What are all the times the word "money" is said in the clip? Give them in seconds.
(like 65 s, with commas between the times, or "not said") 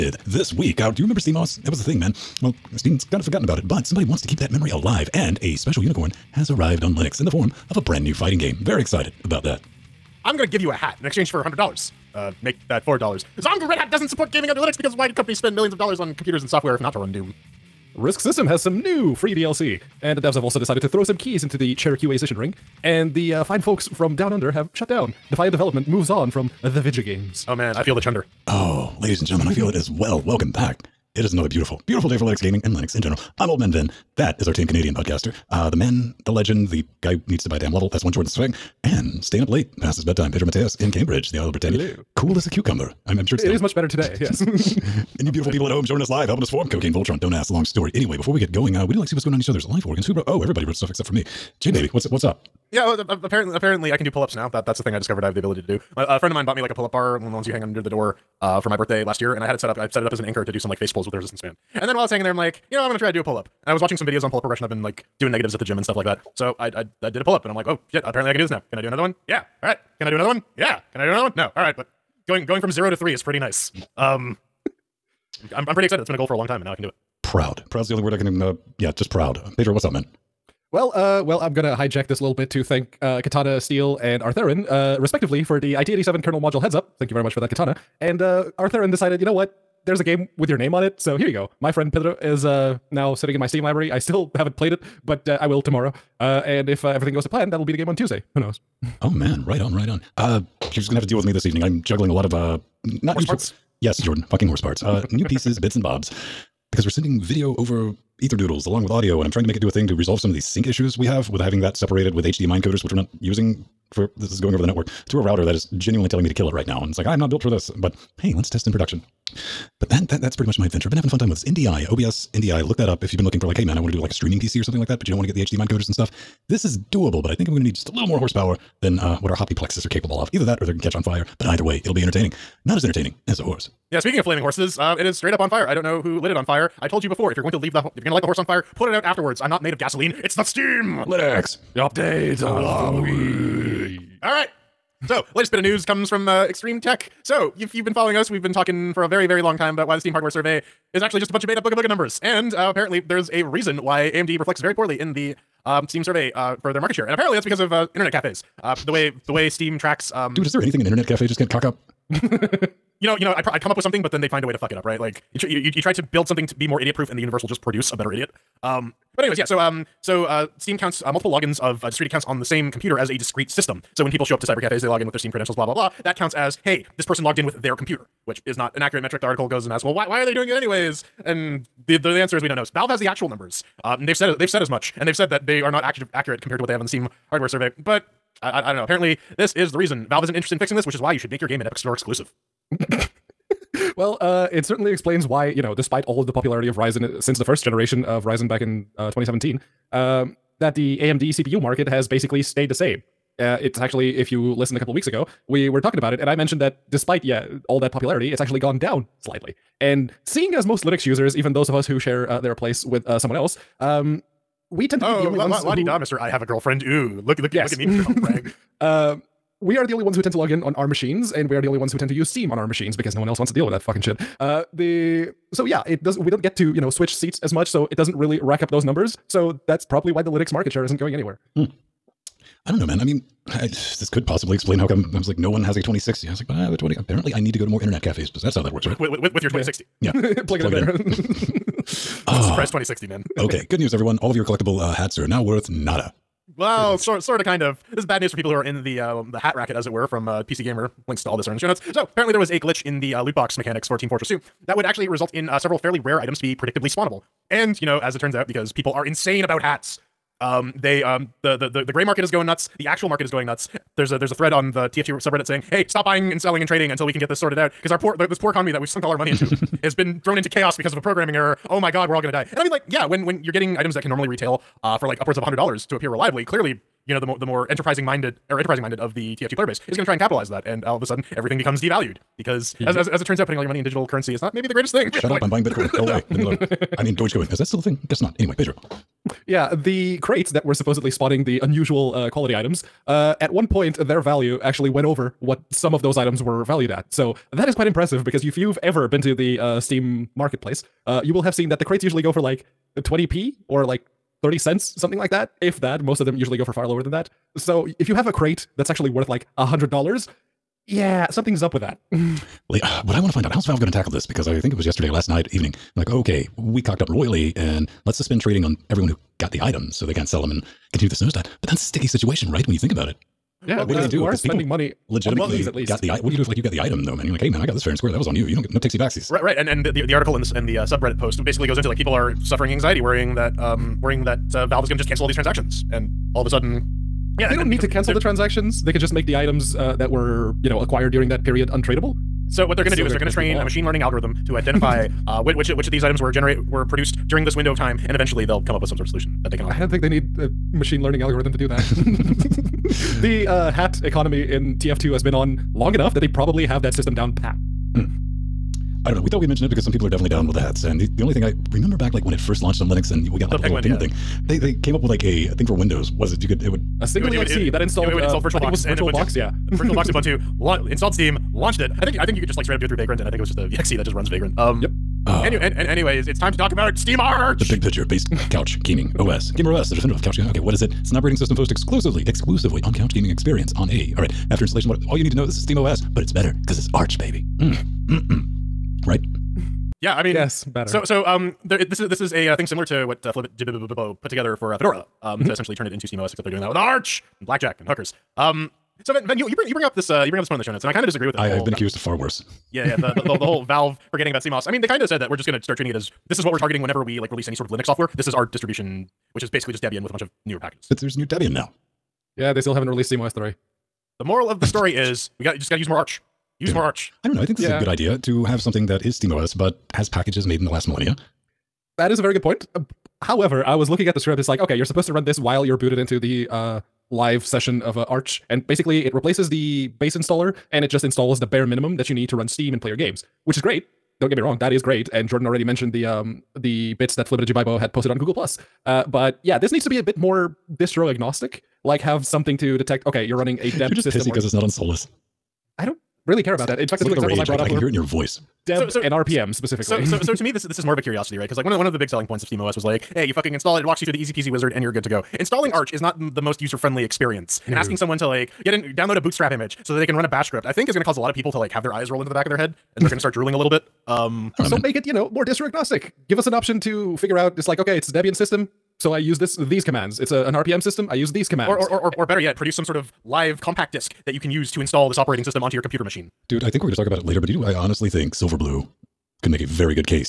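269 s, 283 s, 324 s.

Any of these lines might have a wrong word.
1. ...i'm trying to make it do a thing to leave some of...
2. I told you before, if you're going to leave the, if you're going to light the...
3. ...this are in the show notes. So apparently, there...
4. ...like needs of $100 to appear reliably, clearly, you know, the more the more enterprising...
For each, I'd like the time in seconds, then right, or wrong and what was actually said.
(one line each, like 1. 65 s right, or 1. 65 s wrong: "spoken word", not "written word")
1. 109 s wrong: "resolve", not "leave"
2. 136 s right
3. 251 s right
4. 275 s wrong: "upwards", not "needs".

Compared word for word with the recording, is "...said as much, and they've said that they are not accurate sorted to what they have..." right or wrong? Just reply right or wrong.
wrong.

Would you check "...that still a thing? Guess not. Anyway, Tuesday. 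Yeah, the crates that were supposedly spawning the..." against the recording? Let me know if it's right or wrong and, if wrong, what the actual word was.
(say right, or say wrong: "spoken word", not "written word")
wrong: "Pedro", not "Tuesday".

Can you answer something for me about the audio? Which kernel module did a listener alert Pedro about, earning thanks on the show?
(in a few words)
IT87.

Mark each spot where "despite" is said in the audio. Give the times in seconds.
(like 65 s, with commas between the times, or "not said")
195 s, 206 s.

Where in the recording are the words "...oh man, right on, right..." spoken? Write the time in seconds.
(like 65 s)
99 s.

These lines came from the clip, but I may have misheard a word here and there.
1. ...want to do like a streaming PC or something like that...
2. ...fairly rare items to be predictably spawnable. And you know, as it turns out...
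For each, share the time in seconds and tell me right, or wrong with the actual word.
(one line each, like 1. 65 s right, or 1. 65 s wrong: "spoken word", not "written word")
1. 123 s right
2. 255 s right.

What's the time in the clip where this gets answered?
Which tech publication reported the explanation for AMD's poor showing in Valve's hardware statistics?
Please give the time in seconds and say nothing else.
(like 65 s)
146 s.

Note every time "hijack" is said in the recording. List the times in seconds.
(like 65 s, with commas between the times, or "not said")
81 s.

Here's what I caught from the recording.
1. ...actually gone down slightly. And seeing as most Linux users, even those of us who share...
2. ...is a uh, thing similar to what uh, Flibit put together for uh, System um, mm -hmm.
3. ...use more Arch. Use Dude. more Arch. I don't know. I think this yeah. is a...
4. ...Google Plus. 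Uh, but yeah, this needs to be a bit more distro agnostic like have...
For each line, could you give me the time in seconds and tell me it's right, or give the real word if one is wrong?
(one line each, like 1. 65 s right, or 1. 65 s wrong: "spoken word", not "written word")
1. 208 s right
2. 392 s wrong: "Fedora", not "System"
3. 415 s right
4. 438 s right.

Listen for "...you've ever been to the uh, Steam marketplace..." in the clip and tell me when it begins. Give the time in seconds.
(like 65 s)
298 s.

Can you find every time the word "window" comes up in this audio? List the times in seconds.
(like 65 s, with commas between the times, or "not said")
347 s, 365 s.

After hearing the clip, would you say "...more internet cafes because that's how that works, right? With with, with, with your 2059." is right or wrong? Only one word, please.
wrong.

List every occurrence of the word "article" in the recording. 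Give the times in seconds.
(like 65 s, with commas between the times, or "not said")
179 s, 330 s.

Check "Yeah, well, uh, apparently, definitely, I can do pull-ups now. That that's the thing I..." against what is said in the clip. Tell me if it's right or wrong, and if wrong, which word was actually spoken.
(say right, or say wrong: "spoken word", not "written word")
wrong: "apparently", not "definitely".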